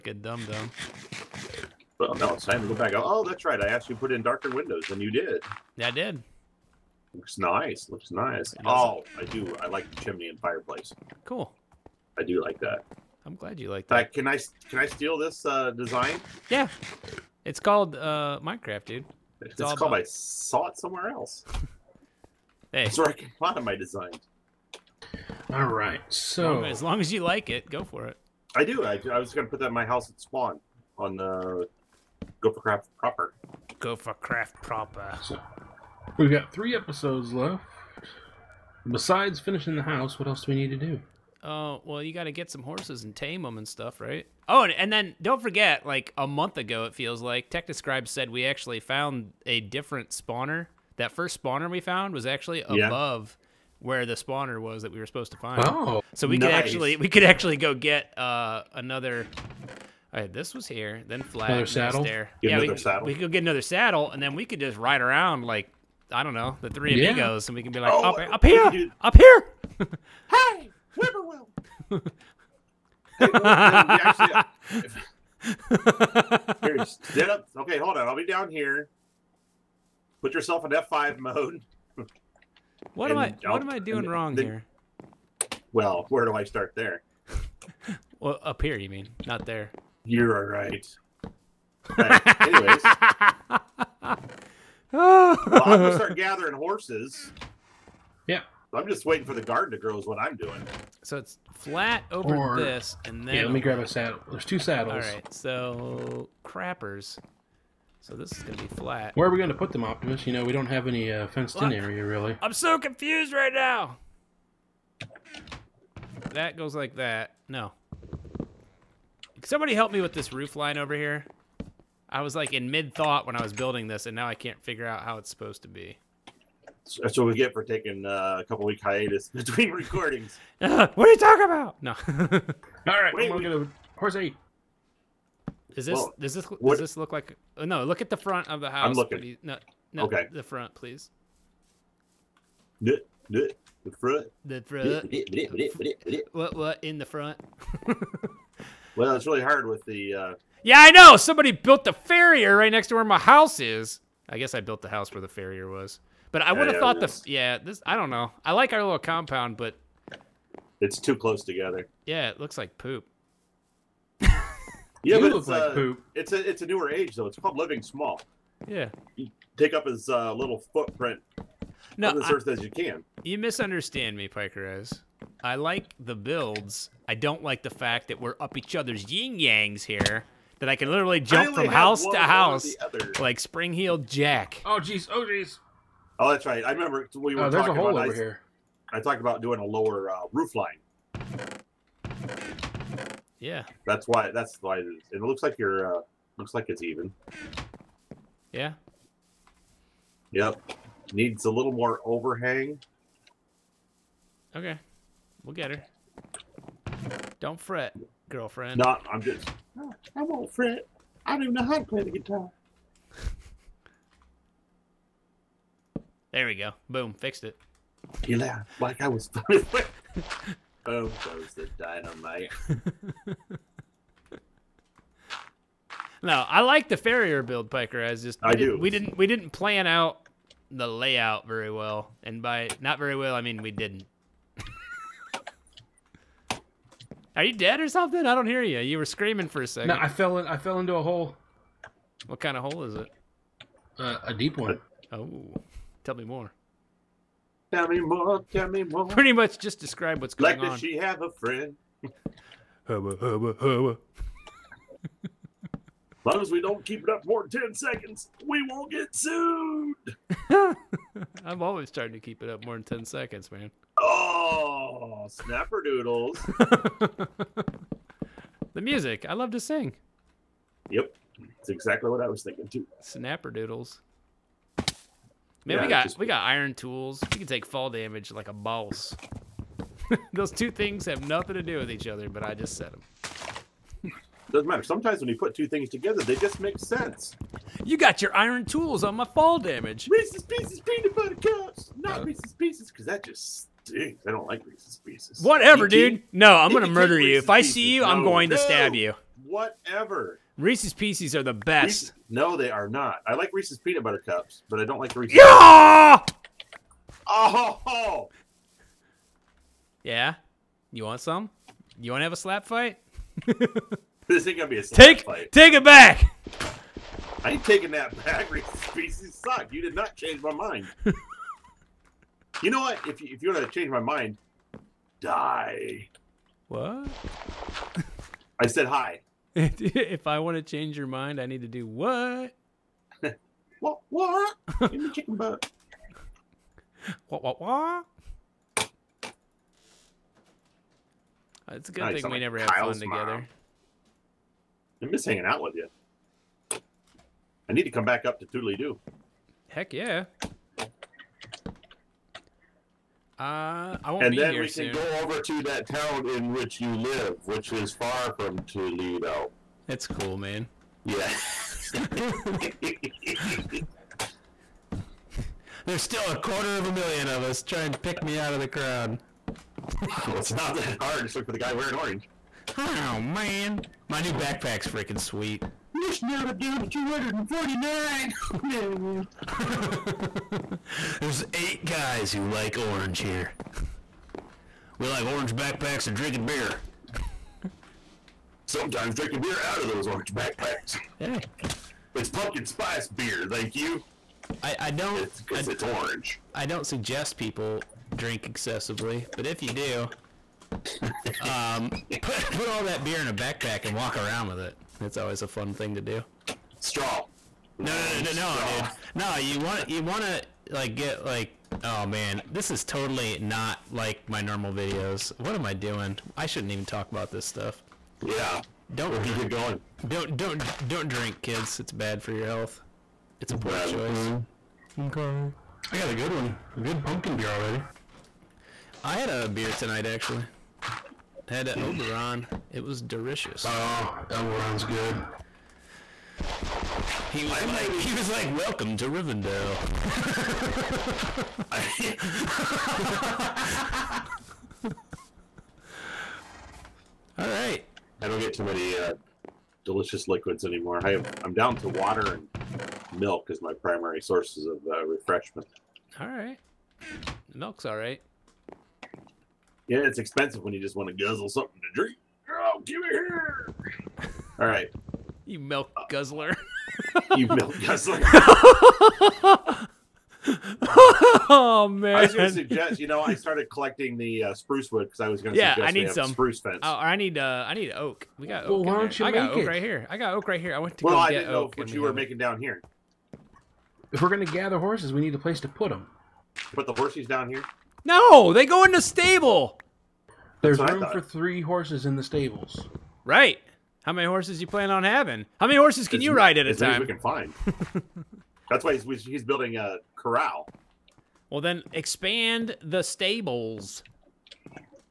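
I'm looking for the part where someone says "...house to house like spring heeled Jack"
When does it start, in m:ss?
3:01.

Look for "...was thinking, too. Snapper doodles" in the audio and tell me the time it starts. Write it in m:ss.
4:32.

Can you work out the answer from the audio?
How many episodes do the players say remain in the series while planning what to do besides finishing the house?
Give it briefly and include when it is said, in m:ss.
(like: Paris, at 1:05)
3, at 0:36.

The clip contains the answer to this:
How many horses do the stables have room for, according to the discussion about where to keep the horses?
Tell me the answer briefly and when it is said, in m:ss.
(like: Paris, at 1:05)
3, at 8:11.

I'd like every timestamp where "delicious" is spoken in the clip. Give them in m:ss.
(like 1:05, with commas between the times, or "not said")
7:13, 7:29.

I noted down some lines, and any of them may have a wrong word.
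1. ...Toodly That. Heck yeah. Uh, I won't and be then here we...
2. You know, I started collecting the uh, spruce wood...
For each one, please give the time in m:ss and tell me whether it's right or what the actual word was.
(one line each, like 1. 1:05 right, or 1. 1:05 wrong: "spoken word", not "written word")
1. 5:48 wrong: "Doo", not "That"
2. 7:52 right.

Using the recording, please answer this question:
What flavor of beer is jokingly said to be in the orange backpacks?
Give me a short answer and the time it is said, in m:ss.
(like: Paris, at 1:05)
Pumpkin spice, at 6:32.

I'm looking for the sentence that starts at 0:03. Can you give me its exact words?
I asked you to put in darker windows, and you did.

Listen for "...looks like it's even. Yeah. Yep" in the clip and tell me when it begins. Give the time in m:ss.
3:16.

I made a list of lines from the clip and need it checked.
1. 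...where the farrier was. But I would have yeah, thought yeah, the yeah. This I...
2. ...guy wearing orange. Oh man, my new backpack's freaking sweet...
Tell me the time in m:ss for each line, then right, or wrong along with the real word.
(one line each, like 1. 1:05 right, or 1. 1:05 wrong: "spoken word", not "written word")
1. 2:35 right
2. 6:11 right.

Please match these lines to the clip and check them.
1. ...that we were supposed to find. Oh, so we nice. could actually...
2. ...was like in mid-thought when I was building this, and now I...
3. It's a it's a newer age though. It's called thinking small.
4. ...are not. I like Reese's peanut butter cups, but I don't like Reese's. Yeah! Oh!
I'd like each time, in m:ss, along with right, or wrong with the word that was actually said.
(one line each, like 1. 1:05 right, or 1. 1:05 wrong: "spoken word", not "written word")
1. 0:54 right
2. 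2:02 right
3. 2:46 wrong: "living", not "thinking"
4. 5:02 right.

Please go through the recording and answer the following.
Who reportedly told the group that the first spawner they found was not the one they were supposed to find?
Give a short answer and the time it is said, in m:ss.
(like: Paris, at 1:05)
TechDescribe, at 0:47.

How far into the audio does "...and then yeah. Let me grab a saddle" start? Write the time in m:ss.
1:43.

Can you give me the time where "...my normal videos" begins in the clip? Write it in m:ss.
6:54.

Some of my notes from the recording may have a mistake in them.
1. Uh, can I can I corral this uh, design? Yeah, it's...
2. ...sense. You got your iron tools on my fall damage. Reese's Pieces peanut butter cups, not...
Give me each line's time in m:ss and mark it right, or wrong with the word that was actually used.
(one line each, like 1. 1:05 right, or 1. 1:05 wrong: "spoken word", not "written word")
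1. 0:13 wrong: "steal", not "corral"
2. 4:46 right.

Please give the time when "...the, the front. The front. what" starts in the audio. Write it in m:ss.
2:23.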